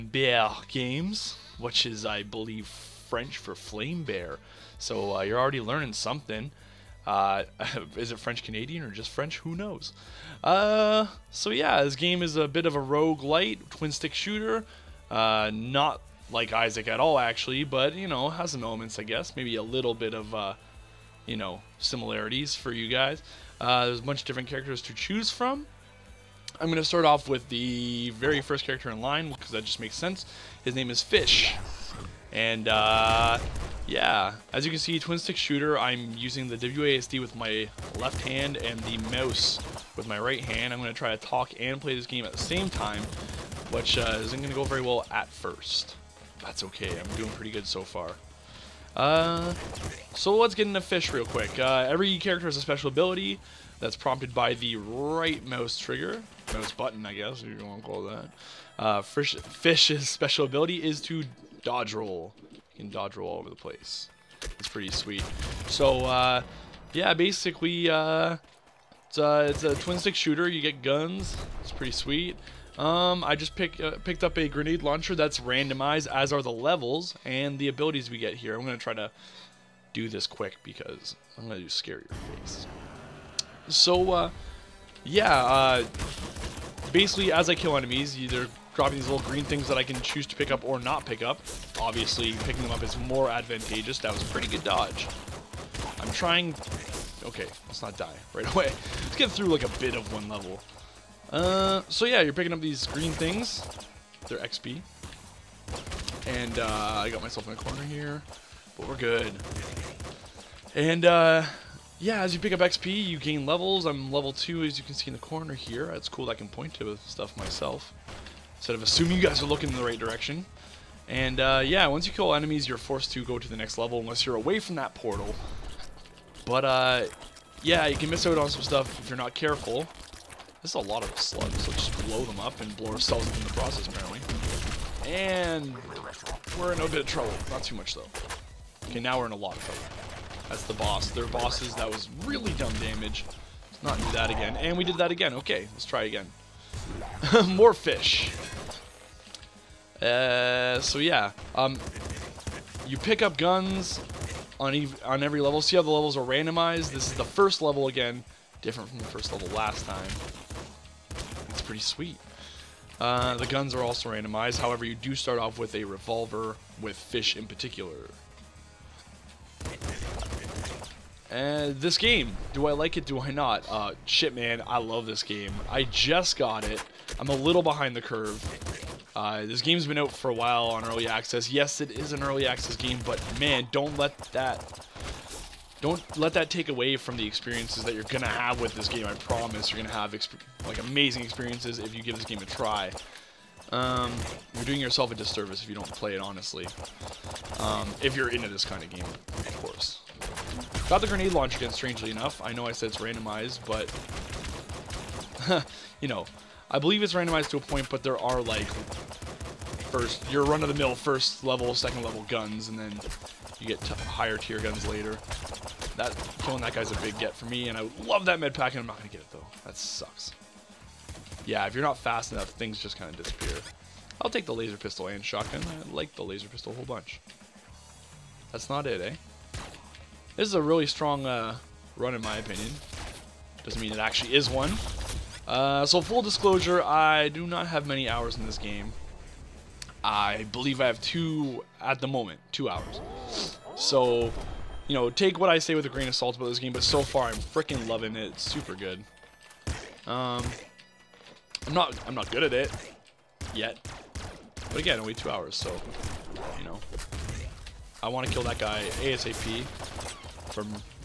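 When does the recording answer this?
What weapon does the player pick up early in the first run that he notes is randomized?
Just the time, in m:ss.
1:14.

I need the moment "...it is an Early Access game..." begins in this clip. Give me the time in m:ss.
3:01.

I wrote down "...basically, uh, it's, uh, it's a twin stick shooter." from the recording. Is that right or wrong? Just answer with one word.
right.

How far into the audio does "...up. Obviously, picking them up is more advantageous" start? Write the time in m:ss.
1:31.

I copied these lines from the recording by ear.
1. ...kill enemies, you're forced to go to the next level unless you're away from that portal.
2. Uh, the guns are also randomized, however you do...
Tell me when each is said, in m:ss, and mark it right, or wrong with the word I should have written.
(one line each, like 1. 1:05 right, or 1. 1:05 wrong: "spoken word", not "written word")
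1. 2:02 right
2. 2:42 right.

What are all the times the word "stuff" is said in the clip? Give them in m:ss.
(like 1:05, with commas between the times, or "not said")
1:57, 2:08.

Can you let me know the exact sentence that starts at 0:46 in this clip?
That's okay, I'm doing pretty good so far.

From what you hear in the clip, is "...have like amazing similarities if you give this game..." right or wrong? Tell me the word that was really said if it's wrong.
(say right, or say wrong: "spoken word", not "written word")
wrong: "experiences", not "similarities".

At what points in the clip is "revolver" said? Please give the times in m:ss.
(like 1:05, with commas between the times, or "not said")
2:45.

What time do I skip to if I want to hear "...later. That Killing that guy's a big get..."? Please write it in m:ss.
3:34.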